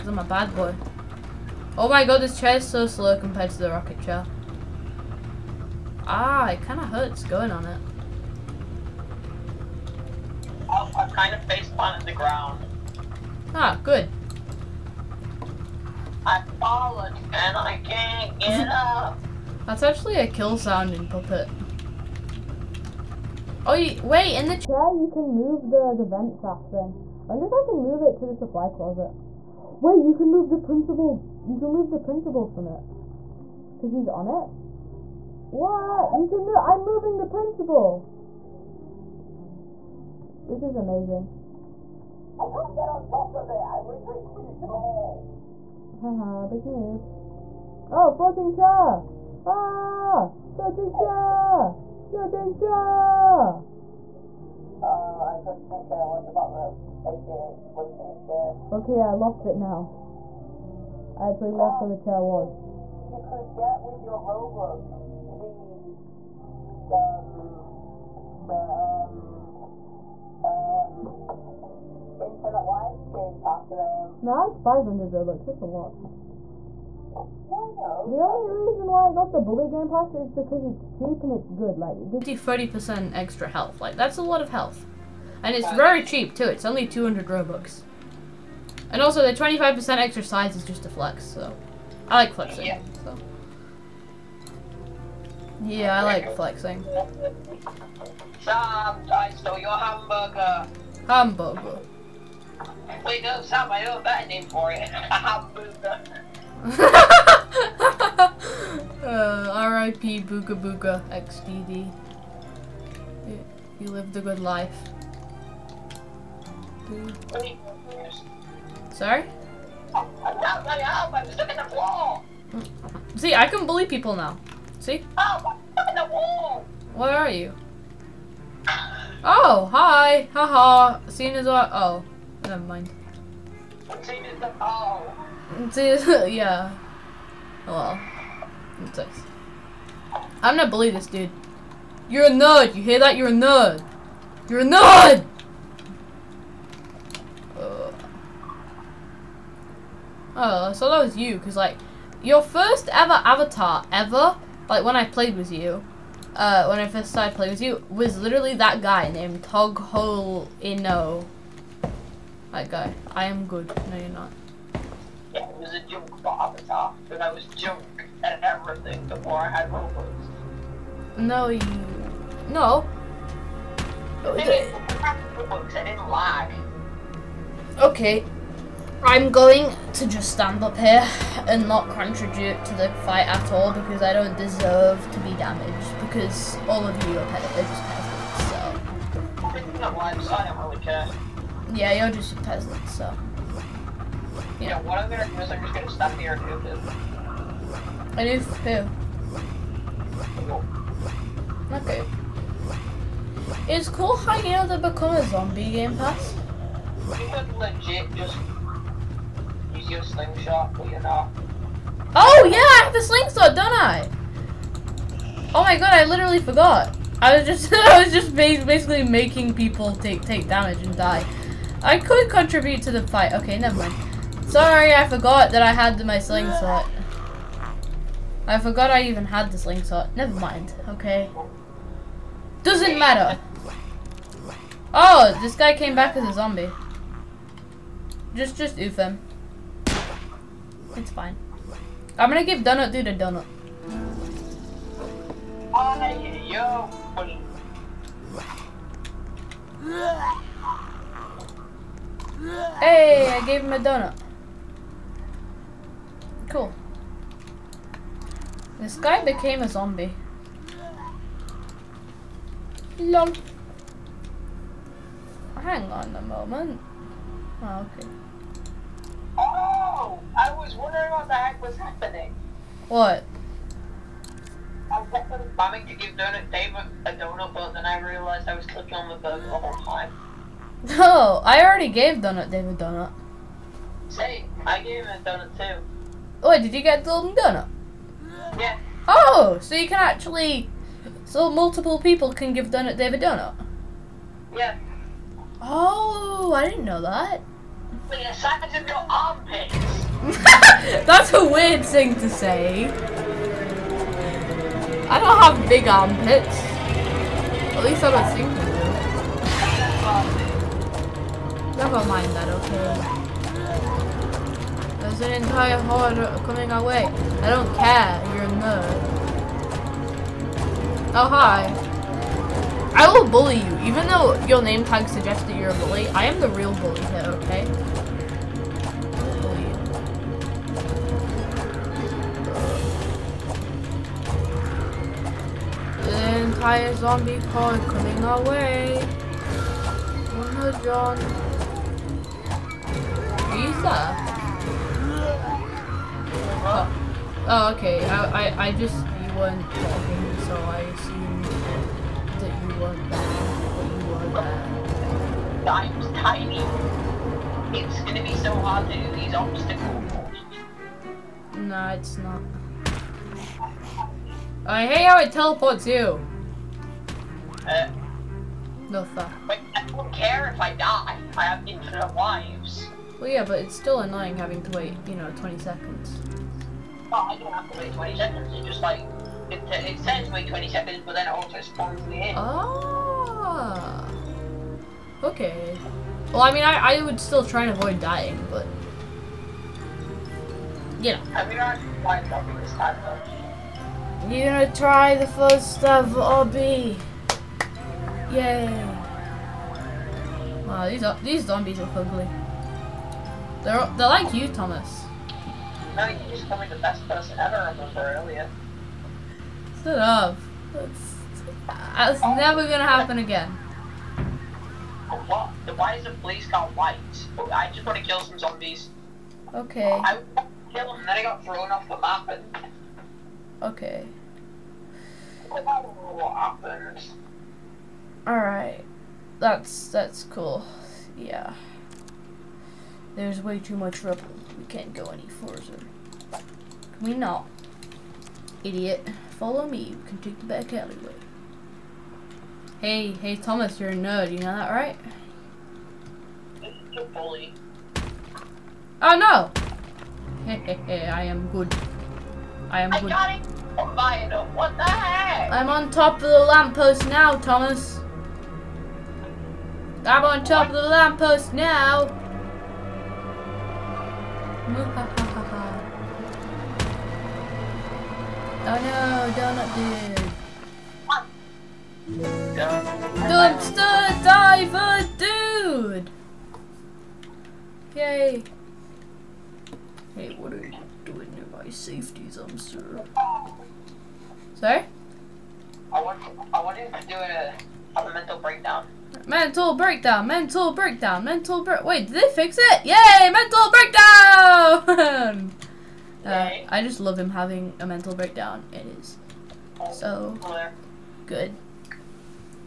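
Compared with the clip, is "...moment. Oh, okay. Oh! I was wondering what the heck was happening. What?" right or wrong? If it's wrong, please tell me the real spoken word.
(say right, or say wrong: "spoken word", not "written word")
right.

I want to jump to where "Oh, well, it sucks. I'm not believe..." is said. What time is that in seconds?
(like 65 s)
137 s.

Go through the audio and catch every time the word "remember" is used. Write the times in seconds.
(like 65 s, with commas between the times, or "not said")
407 s.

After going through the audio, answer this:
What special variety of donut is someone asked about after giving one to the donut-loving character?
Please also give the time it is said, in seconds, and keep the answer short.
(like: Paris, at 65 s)
golden donut, at 287 s.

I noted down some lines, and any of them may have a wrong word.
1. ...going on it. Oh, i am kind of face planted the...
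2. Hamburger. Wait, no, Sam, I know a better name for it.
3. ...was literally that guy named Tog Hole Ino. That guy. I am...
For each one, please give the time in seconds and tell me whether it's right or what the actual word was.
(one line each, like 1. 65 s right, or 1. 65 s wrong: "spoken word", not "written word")
1. 7 s right
2. 101 s right
3. 157 s right.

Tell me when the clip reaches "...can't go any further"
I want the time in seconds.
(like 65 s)
434 s.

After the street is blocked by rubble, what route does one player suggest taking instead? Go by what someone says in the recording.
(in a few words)
back alleyway.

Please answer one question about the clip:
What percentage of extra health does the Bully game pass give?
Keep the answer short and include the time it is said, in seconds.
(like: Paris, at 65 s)
30%, at 82 s.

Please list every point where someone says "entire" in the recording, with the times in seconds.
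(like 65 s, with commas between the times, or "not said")
315 s, 336 s.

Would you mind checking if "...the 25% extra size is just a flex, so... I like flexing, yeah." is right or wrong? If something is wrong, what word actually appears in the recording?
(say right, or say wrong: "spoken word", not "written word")
right.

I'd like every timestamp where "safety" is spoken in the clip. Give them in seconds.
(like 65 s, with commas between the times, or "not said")
481 s.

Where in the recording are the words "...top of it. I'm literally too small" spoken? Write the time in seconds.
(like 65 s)
43 s.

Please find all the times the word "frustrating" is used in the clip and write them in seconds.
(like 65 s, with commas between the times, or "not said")
not said.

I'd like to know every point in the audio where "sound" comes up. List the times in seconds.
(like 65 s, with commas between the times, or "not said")
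20 s.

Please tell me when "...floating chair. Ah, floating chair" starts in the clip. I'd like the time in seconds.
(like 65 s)
48 s.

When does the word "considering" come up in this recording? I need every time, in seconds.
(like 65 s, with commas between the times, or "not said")
not said.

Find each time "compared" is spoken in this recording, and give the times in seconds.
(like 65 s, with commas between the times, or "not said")
3 s.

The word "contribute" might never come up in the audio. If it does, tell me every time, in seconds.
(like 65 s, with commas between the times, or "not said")
181 s, 222 s.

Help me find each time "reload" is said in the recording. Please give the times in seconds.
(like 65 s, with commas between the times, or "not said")
not said.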